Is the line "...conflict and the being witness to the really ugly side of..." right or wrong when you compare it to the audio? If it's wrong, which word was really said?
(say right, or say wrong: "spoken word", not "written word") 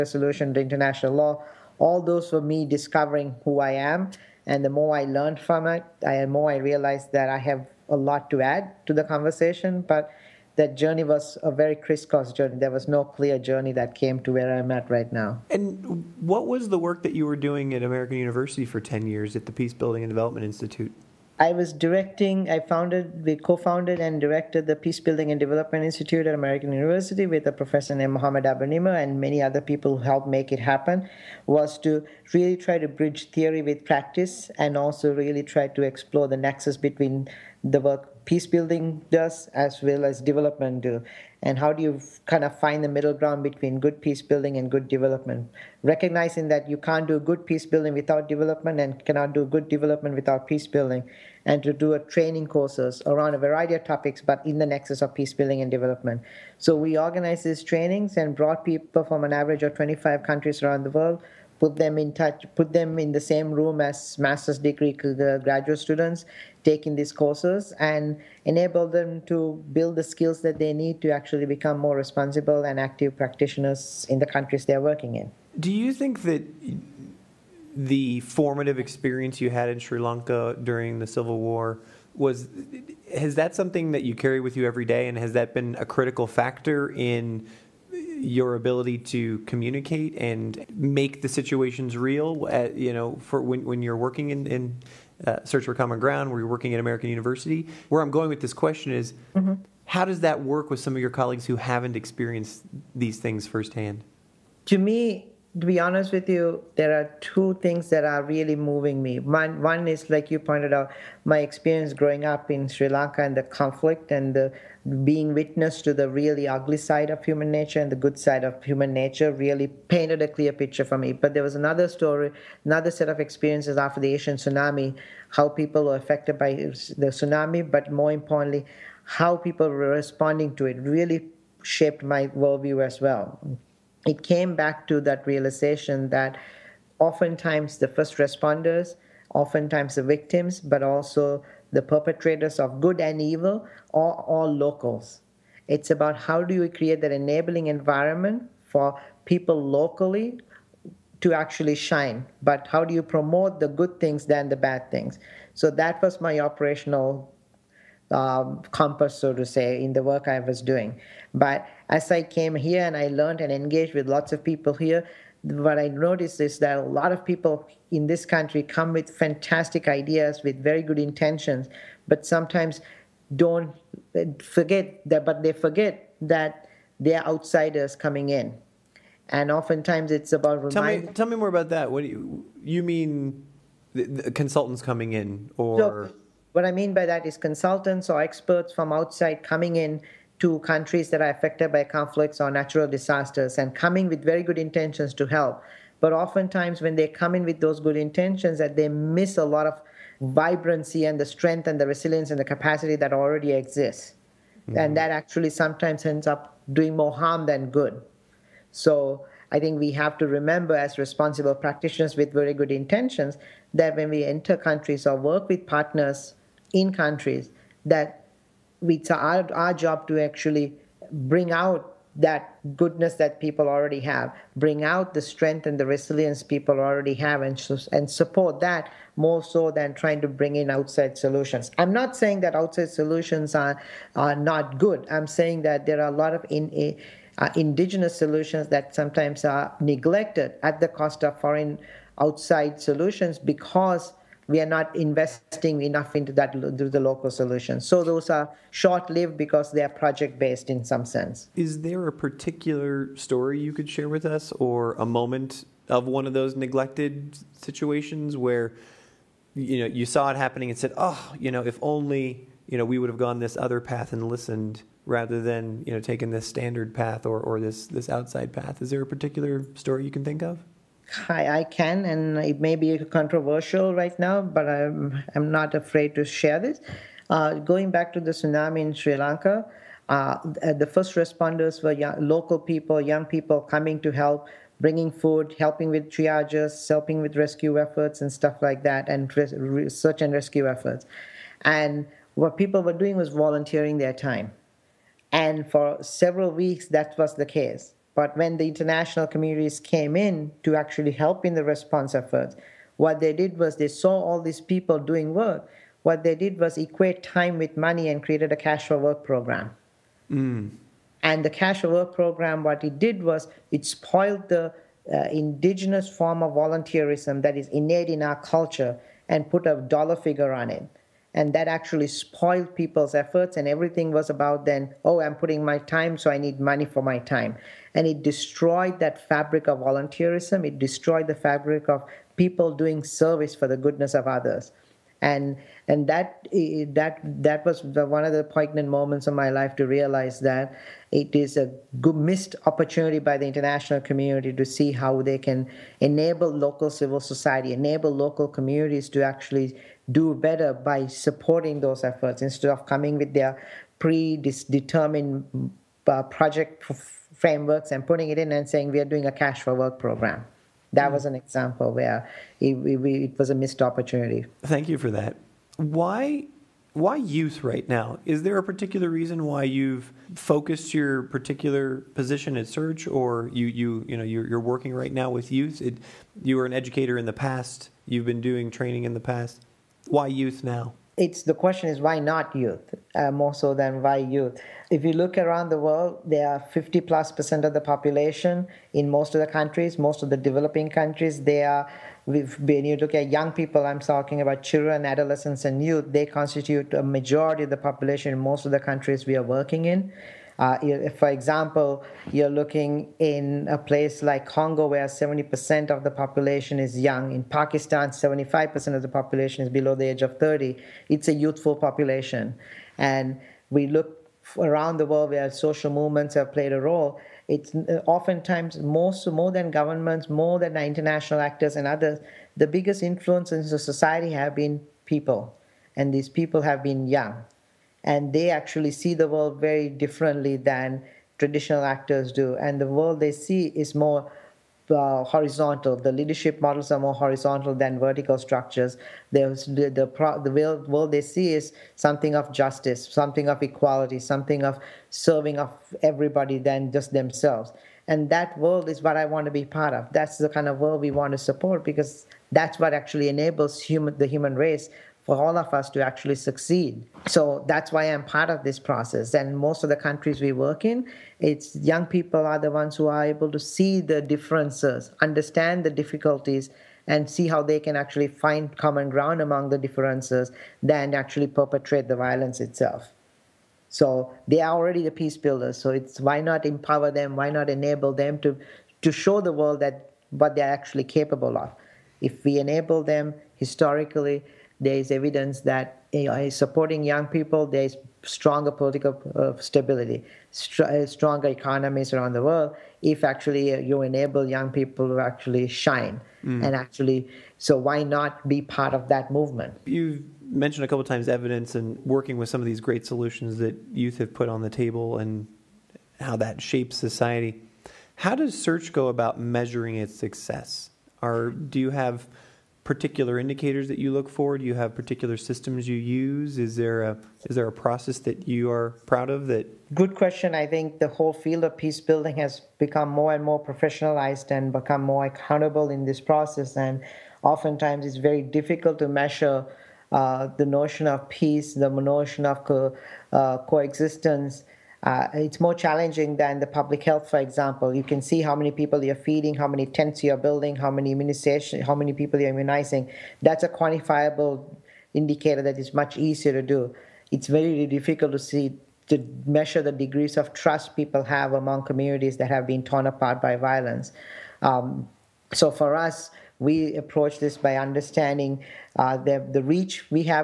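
right.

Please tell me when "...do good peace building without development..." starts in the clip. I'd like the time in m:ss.
0:47.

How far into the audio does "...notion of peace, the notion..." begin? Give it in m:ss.
8:50.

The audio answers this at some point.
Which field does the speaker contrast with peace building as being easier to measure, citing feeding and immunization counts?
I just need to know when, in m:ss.
8:56.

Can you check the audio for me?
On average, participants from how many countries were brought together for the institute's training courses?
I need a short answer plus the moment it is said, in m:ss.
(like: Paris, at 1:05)
25, at 0:59.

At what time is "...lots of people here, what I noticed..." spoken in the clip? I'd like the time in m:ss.
2:44.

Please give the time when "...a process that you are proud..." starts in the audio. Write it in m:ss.
8:37.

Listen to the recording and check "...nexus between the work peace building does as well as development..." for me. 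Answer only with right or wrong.
right.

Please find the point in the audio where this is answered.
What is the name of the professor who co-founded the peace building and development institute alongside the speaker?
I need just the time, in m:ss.
0:28.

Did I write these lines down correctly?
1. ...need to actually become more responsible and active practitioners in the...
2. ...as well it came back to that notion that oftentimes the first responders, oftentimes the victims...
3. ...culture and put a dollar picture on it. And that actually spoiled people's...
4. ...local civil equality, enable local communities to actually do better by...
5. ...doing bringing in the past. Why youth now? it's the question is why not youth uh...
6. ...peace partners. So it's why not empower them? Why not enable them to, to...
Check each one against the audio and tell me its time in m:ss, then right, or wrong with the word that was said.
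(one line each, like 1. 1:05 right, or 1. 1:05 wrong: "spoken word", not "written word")
1. 1:10 right
2. 2:12 wrong: "realization", not "notion"
3. 5:18 wrong: "figure", not "picture"
4. 5:46 wrong: "society", not "equality"
5. 6:18 wrong: "training", not "bringing"
6. 7:55 wrong: "builders", not "partners".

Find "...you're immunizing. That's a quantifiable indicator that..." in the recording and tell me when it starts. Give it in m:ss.
9:02.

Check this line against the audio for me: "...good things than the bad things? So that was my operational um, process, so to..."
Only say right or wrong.
wrong.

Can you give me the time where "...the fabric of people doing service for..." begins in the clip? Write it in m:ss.
5:31.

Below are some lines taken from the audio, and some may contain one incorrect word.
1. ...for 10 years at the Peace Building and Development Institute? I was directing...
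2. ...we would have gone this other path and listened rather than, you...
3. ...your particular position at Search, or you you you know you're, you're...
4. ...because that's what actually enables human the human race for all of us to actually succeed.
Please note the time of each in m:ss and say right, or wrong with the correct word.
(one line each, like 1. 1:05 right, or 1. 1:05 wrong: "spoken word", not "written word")
1. 0:18 right
2. 4:22 right
3. 6:10 right
4. 7:31 right.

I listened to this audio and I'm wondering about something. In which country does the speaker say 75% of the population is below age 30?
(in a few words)
Pakistan.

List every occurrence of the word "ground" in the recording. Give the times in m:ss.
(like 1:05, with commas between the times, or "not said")
0:43, 1:35, 7:49.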